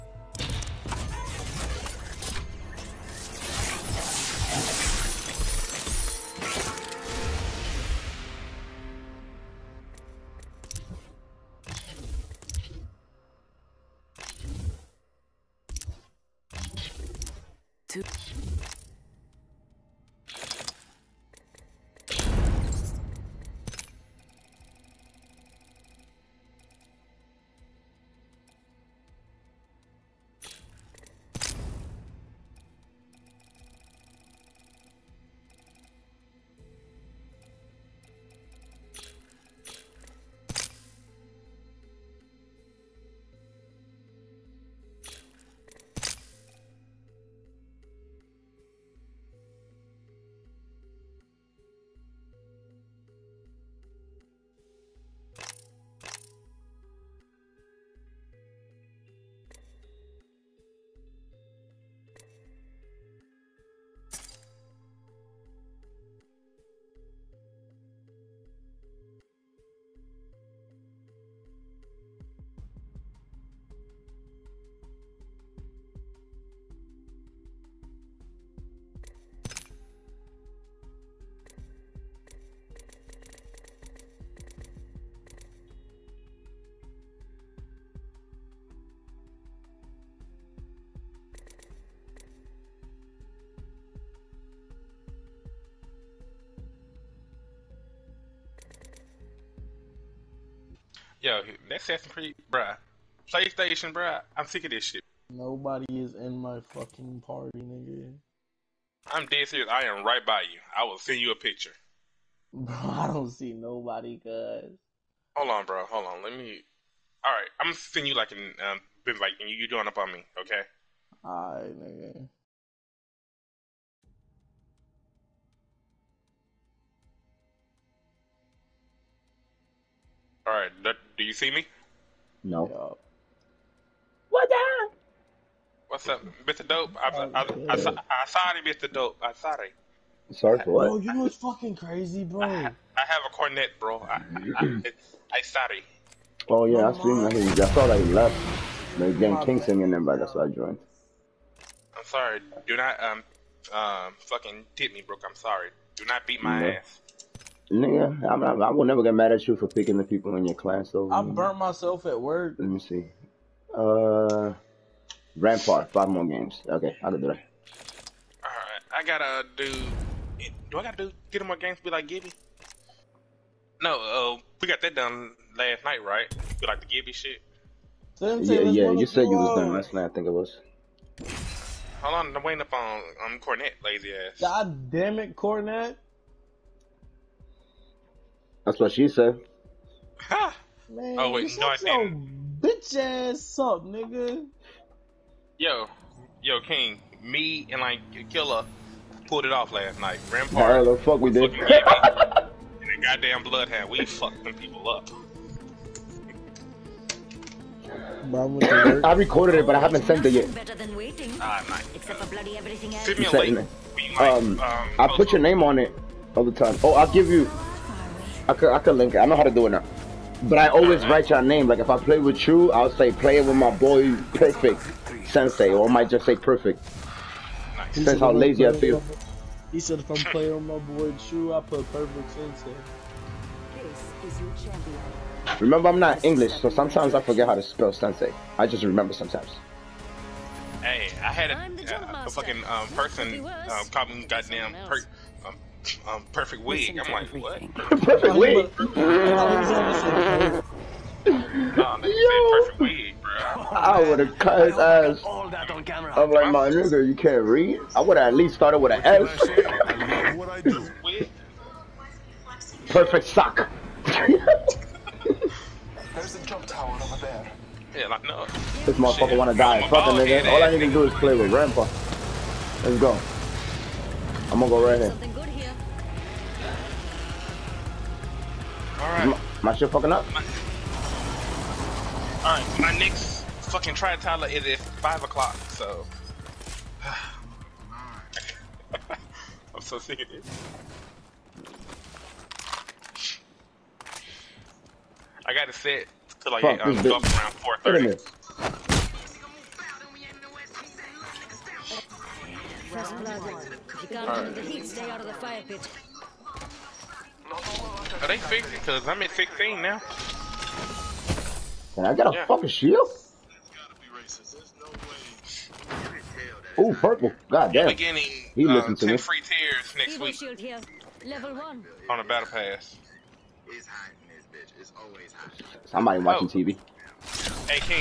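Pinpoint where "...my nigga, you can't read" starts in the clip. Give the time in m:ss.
4:16.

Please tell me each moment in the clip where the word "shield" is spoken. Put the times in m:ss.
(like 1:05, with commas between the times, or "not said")
5:12, 5:20.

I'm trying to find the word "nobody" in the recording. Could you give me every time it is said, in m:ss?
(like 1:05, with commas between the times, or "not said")
1:45, 1:53.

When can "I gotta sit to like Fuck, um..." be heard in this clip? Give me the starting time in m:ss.
4:55.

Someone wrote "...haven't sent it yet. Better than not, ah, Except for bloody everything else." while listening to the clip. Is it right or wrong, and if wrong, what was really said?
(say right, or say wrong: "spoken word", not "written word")
right.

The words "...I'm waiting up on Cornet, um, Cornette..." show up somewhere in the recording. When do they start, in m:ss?
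3:02.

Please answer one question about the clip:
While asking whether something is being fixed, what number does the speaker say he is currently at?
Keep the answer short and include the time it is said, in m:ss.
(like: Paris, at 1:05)
16, at 5:09.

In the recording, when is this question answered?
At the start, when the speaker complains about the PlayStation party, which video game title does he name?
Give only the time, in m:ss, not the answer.
1:41.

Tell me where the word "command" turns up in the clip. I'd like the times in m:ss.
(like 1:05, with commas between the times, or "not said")
not said.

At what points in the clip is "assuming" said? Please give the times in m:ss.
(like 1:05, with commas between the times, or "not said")
not said.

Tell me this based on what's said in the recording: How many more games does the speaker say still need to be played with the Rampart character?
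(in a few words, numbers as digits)
5.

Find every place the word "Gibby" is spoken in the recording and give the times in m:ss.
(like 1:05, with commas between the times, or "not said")
2:52, 2:56.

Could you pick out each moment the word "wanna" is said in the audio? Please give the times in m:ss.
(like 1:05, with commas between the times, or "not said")
4:29.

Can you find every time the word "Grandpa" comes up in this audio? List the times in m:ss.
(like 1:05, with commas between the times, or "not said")
4:31.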